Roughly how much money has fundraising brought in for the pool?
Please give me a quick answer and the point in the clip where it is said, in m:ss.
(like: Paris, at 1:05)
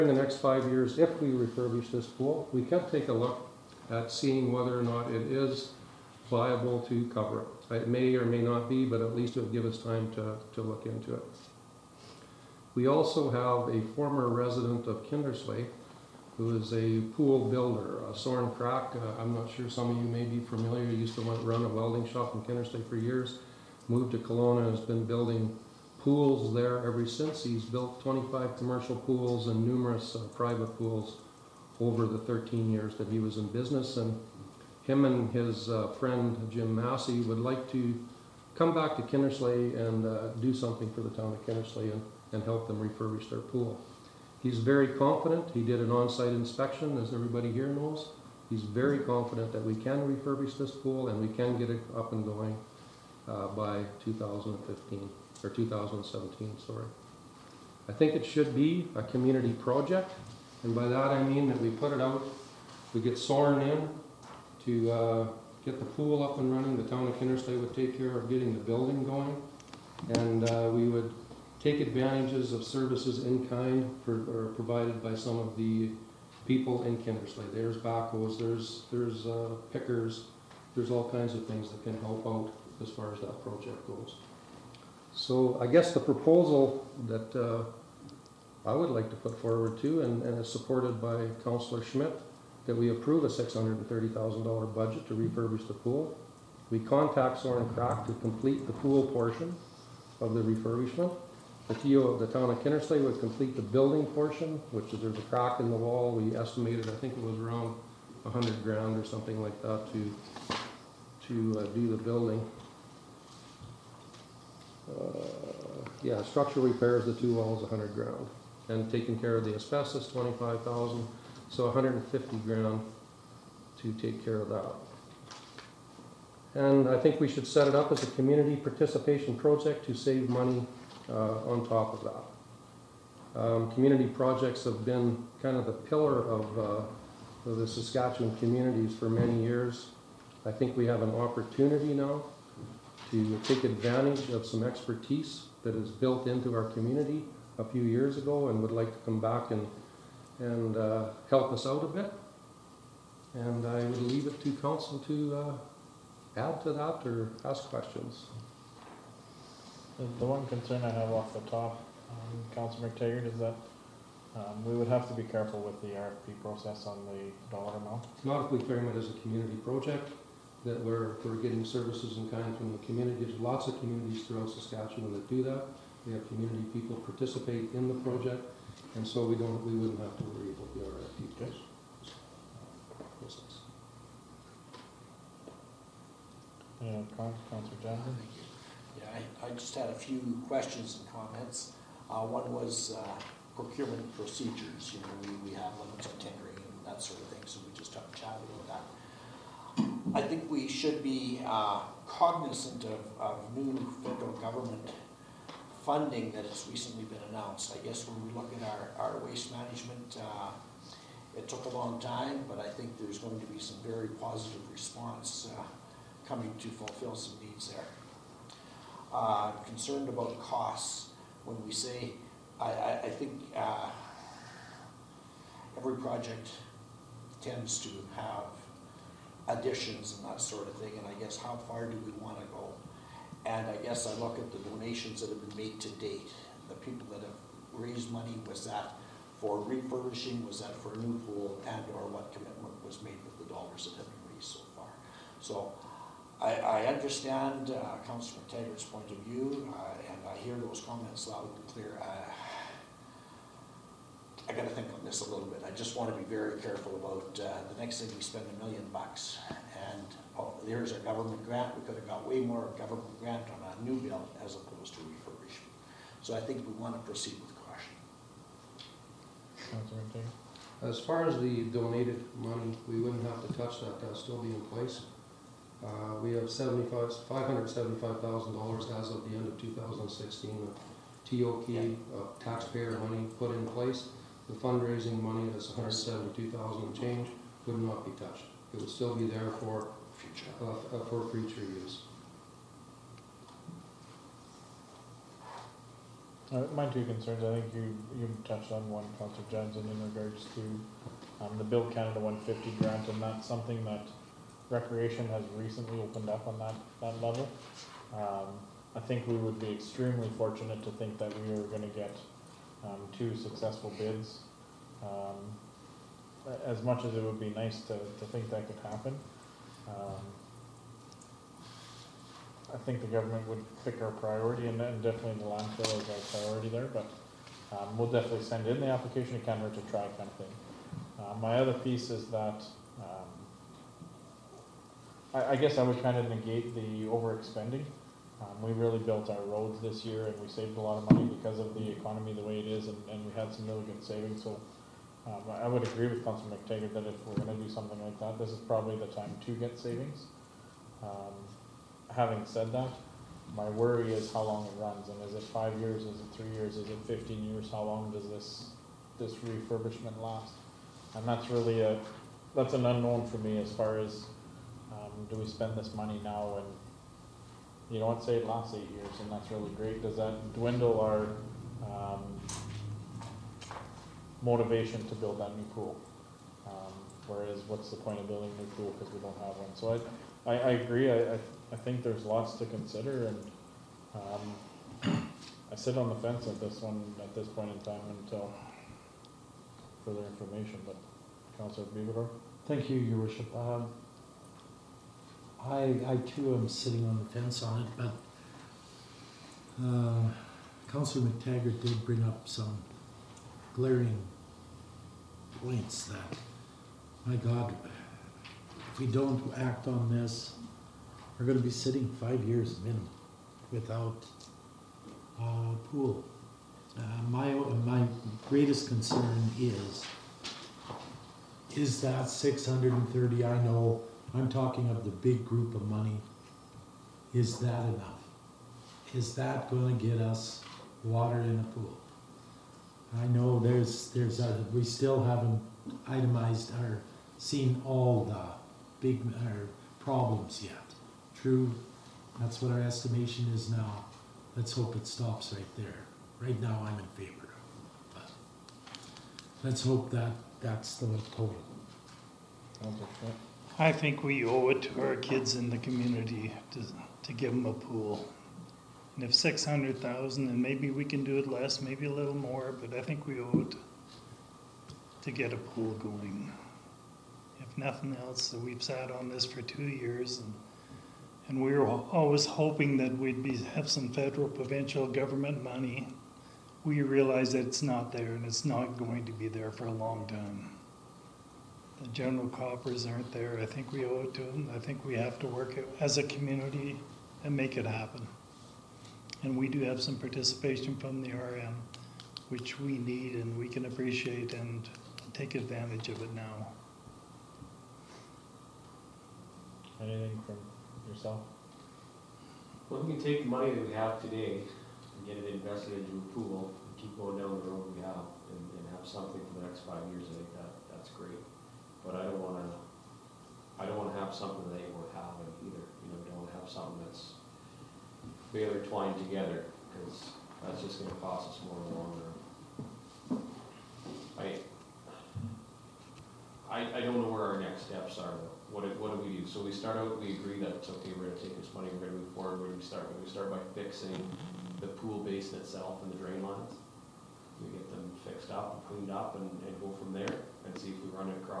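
172,000, at 4:45.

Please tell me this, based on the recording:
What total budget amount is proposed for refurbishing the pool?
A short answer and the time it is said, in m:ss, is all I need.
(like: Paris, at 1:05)
$630,000, at 1:33.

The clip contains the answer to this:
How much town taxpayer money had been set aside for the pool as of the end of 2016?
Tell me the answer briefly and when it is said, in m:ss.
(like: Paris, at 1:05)
$575,000, at 4:36.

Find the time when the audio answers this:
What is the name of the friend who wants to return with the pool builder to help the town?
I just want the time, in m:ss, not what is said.
0:36.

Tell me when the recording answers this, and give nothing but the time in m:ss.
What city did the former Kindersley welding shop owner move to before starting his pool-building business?
0:24.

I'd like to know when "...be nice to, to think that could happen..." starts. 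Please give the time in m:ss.
5:17.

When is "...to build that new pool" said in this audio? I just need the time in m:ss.
6:15.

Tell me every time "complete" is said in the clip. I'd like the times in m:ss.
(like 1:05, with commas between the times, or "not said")
1:38, 1:43.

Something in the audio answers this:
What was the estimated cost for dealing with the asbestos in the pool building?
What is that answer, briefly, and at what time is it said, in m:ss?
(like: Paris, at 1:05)
25,000, at 2:00.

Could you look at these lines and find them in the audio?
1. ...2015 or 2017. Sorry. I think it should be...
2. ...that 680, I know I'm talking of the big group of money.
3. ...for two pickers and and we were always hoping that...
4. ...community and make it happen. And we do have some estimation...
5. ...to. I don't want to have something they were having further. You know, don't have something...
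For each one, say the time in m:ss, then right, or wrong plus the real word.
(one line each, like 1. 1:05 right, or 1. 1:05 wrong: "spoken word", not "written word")
1. 0:54 right
2. 7:02 wrong: "630", not "680"
3. 7:49 wrong: "years", not "pickers"
4. 8:06 wrong: "participation", not "estimation"
5. 8:32 wrong: "either", not "further".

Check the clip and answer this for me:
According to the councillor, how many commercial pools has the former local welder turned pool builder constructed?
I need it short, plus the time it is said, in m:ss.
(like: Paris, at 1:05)
25, at 0:28.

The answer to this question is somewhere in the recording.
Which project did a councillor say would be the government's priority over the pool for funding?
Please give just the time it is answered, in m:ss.
5:25.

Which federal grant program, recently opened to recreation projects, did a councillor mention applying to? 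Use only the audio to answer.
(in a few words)
Build Canada 150.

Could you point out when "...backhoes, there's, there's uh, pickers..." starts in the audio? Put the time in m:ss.
1:17.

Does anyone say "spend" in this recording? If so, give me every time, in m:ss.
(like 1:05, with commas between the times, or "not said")
4:18, 6:05.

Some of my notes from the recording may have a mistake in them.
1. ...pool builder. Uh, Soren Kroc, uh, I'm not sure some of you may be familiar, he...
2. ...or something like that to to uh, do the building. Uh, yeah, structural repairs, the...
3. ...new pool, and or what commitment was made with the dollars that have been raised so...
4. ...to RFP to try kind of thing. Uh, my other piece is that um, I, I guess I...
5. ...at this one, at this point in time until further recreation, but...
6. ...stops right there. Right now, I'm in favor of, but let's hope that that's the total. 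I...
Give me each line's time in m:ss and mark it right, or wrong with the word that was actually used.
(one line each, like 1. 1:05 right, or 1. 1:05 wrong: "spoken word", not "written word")
1. 0:17 right
2. 1:48 right
3. 4:00 right
4. 5:29 wrong: "Canada", not "RFP"
5. 6:26 wrong: "information", not "recreation"
6. 7:25 right.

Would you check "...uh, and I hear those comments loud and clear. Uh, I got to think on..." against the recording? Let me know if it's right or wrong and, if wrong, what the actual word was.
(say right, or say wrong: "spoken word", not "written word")
right.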